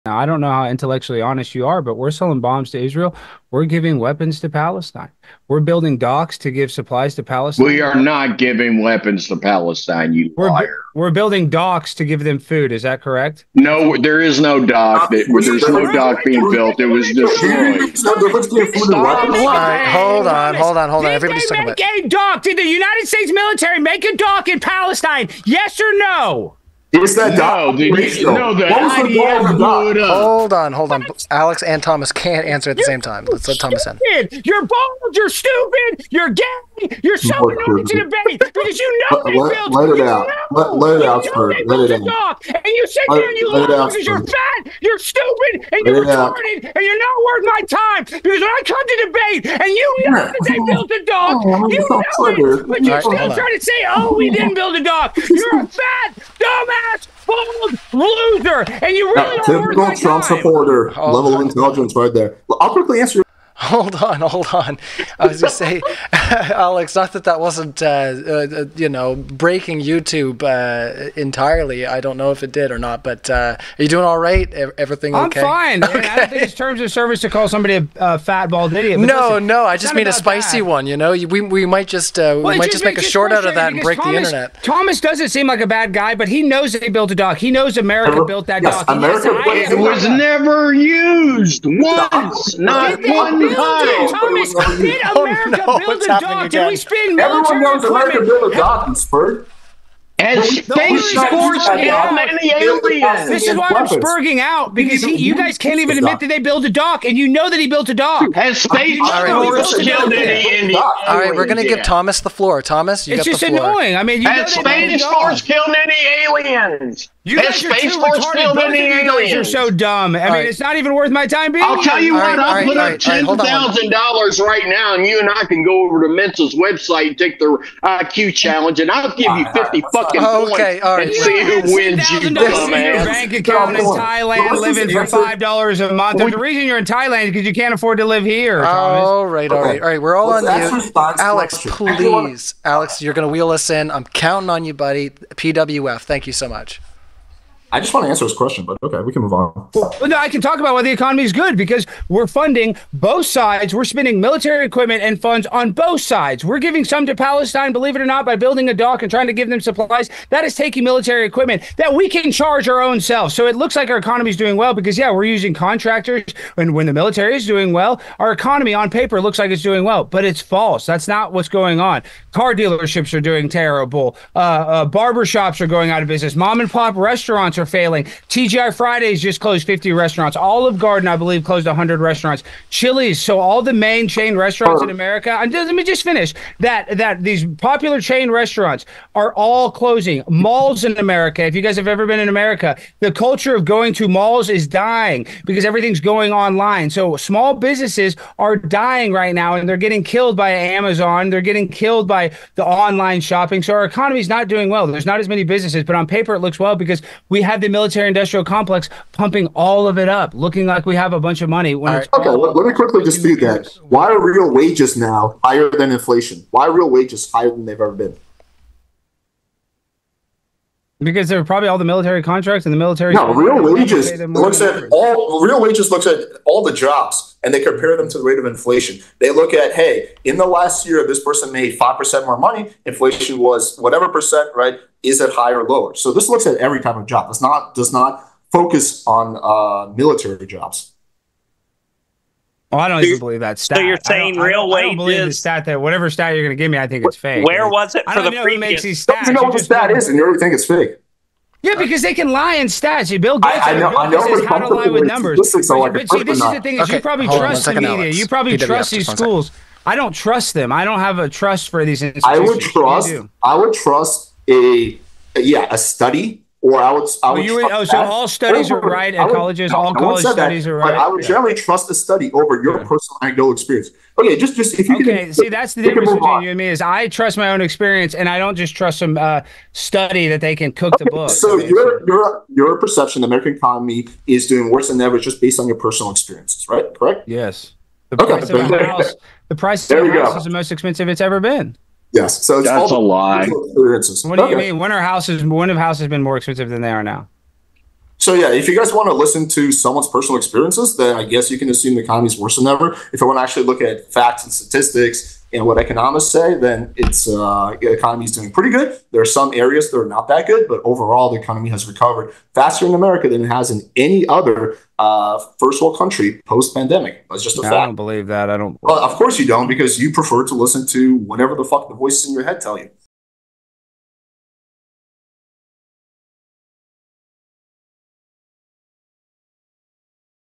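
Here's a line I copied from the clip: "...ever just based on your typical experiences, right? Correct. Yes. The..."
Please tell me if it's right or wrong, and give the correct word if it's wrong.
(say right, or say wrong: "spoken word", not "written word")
wrong: "personal", not "typical".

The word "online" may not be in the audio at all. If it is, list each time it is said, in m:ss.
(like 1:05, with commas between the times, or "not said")
3:16, 3:22.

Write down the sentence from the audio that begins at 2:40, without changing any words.
That is taking military equipment that we can charge our own selves.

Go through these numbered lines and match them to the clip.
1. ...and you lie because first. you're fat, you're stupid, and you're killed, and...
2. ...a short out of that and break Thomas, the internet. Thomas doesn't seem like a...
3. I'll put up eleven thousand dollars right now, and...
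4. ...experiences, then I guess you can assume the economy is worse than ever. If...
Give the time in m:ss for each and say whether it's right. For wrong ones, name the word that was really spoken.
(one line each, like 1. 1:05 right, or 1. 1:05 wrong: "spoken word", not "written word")
1. 0:43 wrong: "retarded", not "killed"
2. 1:22 right
3. 2:02 wrong: "ten", not "eleven"
4. 5:00 right.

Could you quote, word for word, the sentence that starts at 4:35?
Can, see, that's the difference between on.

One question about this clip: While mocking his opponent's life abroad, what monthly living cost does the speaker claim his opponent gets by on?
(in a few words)
$5 a month.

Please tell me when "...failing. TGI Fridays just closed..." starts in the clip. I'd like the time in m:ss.
2:57.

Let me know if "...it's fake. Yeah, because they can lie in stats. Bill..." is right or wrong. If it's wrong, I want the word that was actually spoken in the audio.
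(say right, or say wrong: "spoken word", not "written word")
right.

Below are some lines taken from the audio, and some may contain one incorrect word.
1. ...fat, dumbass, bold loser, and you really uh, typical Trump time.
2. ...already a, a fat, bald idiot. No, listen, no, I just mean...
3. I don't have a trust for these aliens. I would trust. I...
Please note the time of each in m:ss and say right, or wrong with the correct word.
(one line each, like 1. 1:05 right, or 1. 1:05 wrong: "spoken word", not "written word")
1. 0:55 right
2. 1:17 wrong: "somebody", not "already"
3. 4:20 wrong: "institutions", not "aliens".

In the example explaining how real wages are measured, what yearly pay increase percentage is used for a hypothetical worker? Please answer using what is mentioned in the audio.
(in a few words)
5%.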